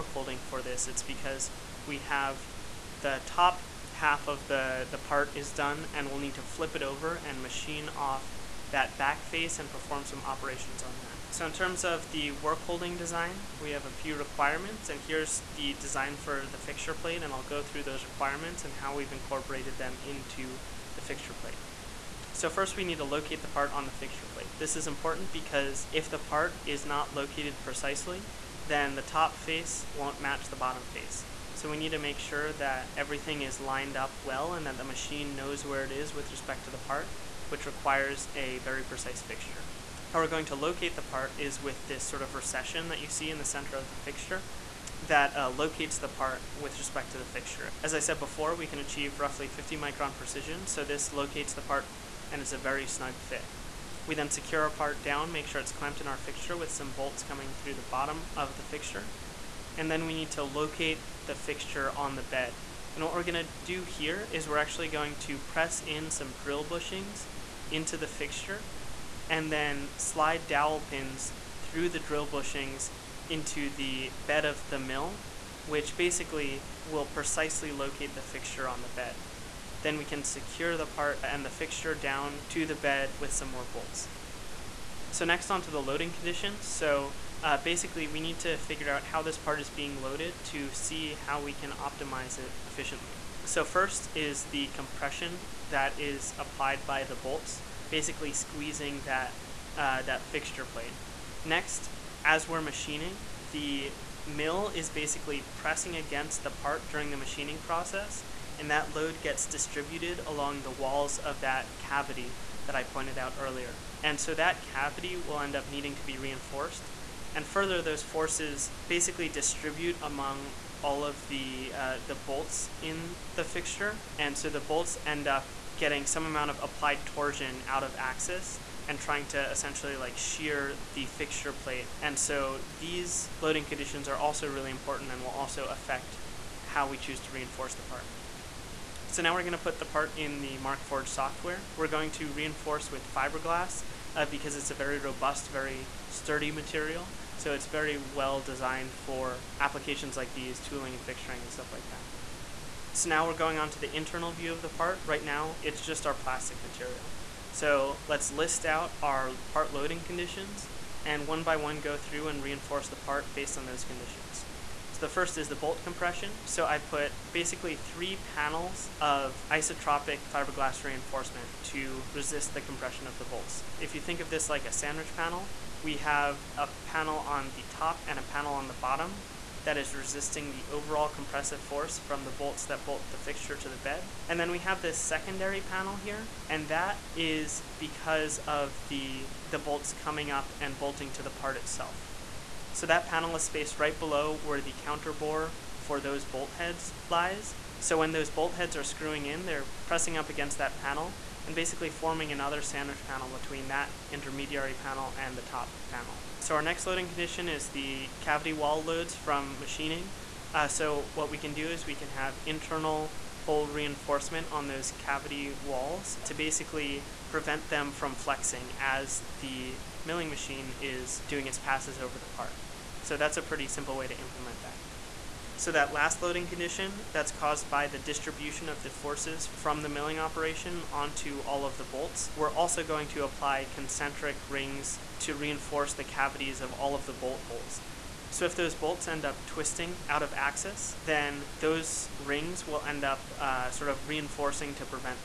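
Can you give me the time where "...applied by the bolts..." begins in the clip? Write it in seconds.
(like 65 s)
96 s.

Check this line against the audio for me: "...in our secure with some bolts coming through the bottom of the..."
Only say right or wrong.
wrong.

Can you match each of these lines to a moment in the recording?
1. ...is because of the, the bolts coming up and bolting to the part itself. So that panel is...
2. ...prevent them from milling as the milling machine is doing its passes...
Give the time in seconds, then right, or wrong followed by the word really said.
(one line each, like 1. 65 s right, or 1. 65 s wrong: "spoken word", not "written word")
1. 187 s right
2. 217 s wrong: "flexing", not "milling".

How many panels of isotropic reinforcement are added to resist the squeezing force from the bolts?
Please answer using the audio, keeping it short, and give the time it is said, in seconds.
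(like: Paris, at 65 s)
3, at 167 s.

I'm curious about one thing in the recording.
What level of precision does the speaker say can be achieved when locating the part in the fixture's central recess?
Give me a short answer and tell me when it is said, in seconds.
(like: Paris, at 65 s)
50 micron, at 49 s.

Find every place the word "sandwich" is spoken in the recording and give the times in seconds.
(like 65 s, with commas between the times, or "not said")
174 s, 202 s.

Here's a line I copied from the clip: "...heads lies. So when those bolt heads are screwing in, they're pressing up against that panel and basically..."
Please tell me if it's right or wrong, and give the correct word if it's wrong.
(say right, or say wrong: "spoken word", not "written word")
right.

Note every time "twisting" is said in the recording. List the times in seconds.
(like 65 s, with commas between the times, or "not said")
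239 s.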